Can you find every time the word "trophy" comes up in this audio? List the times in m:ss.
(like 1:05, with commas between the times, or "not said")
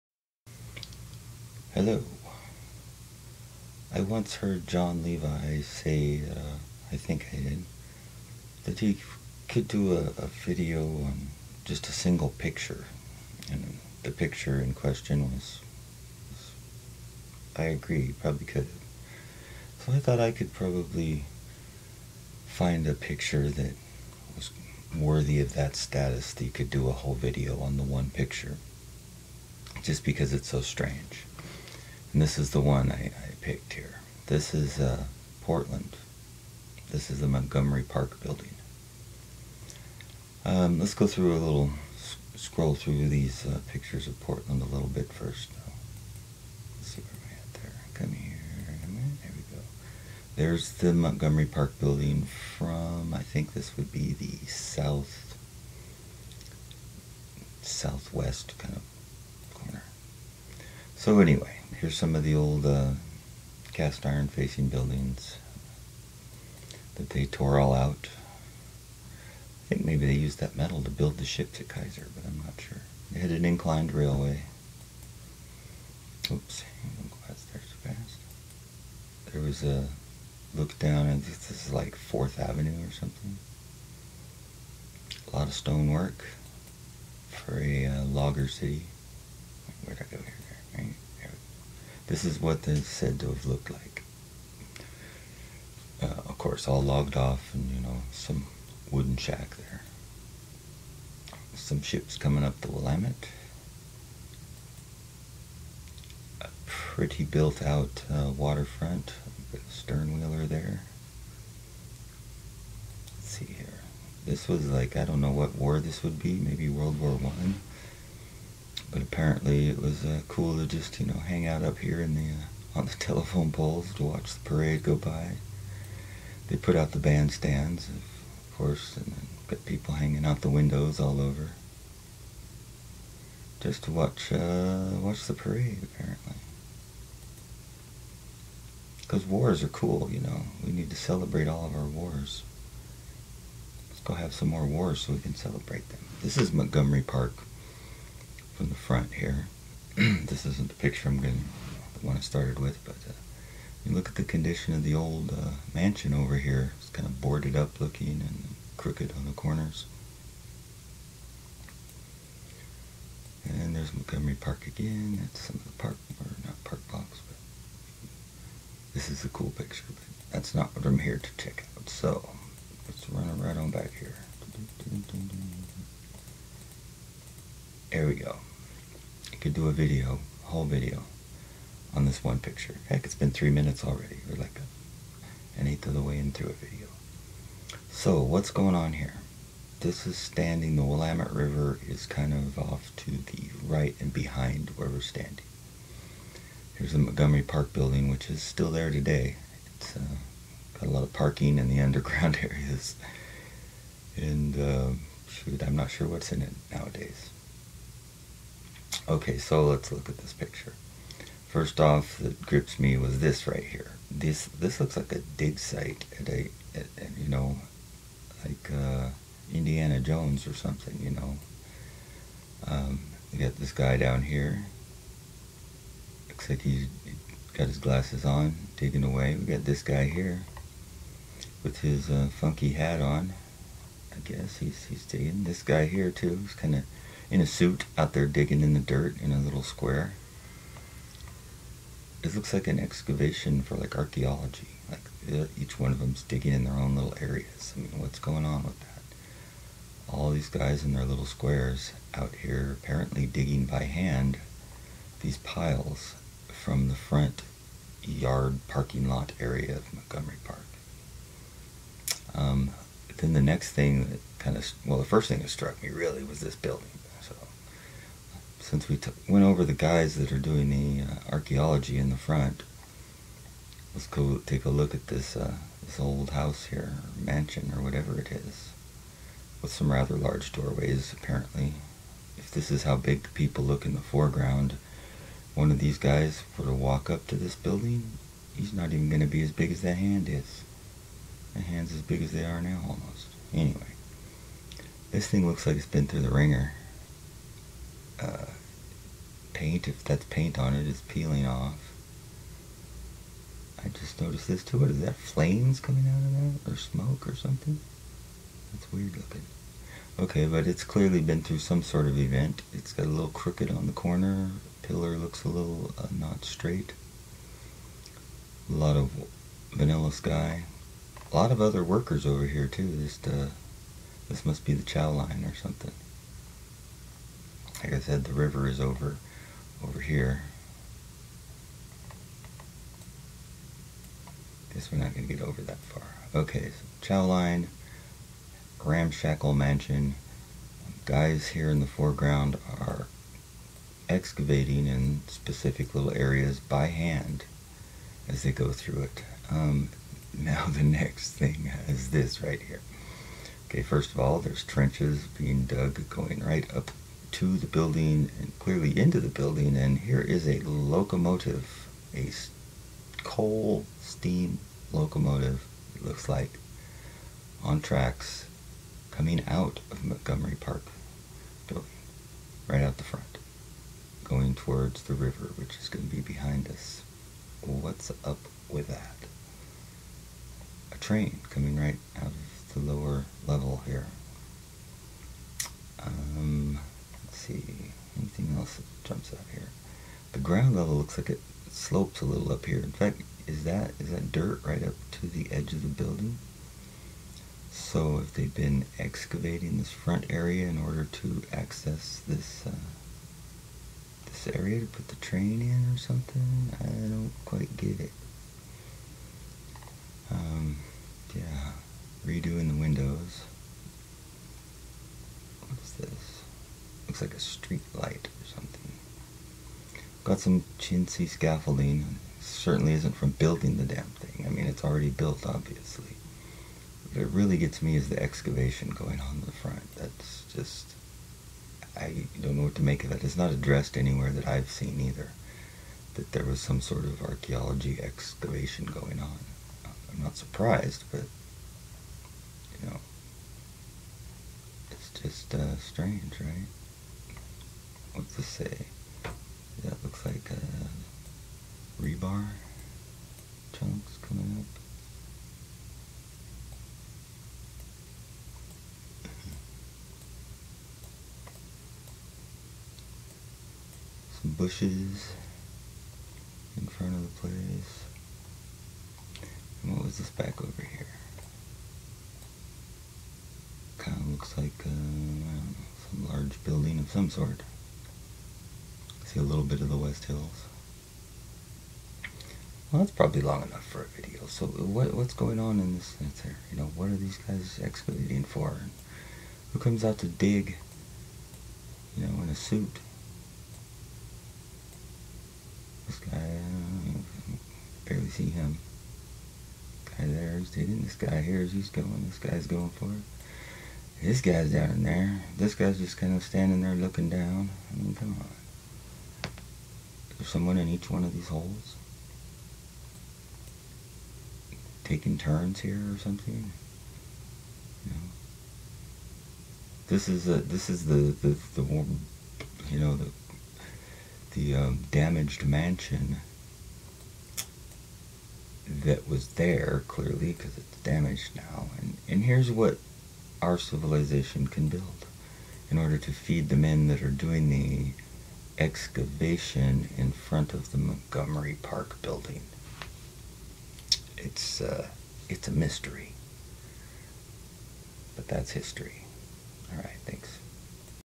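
not said.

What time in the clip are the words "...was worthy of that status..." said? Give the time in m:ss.
0:24.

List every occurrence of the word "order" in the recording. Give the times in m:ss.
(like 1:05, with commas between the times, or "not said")
6:40, 8:55.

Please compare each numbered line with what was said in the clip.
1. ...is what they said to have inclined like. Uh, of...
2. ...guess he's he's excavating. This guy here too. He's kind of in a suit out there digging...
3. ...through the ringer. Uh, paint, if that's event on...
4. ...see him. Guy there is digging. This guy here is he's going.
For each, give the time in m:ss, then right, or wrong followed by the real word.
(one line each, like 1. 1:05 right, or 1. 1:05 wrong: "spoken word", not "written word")
1. 1:32 wrong: "looked", not "inclined"
2. 3:54 wrong: "digging", not "excavating"
3. 4:56 wrong: "paint", not "event"
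4. 8:18 right.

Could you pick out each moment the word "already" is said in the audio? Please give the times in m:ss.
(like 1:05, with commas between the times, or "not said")
3:03, 7:04.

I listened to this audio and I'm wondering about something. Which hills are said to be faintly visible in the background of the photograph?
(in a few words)
West Hills.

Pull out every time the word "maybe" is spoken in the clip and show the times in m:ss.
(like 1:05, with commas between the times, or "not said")
1:09, 1:56.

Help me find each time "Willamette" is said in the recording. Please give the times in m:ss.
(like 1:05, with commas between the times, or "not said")
1:42, 3:10.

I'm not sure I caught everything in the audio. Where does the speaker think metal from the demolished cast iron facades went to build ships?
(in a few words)
Kaiser.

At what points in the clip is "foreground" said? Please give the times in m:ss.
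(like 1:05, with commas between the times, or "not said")
4:44, 5:41.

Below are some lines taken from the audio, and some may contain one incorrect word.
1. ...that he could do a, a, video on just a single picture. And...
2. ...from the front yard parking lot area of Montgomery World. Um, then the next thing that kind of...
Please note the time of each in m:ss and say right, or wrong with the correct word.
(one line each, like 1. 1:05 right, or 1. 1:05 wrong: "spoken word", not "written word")
1. 0:08 right
2. 4:16 wrong: "Park", not "World".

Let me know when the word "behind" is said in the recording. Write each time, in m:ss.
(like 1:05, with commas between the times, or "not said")
3:14, 6:16.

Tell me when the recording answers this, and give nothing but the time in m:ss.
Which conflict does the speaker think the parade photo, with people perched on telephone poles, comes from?
1:56.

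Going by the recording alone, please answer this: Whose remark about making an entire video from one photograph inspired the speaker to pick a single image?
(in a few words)
Jon Levi.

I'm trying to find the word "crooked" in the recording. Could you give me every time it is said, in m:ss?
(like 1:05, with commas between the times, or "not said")
2:38, 5:13.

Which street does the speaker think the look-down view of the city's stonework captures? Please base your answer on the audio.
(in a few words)
4th Avenue.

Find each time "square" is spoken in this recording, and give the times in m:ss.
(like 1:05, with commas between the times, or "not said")
3:59, 4:11.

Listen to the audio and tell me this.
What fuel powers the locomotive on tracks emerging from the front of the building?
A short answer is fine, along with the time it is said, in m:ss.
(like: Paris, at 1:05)
coal steam, at 6:03.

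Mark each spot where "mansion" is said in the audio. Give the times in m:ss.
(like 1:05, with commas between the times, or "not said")
2:35, 4:37, 5:39, 8:45.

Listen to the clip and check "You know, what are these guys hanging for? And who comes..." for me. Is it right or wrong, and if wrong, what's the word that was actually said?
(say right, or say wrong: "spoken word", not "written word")
wrong: "excavating", not "hanging".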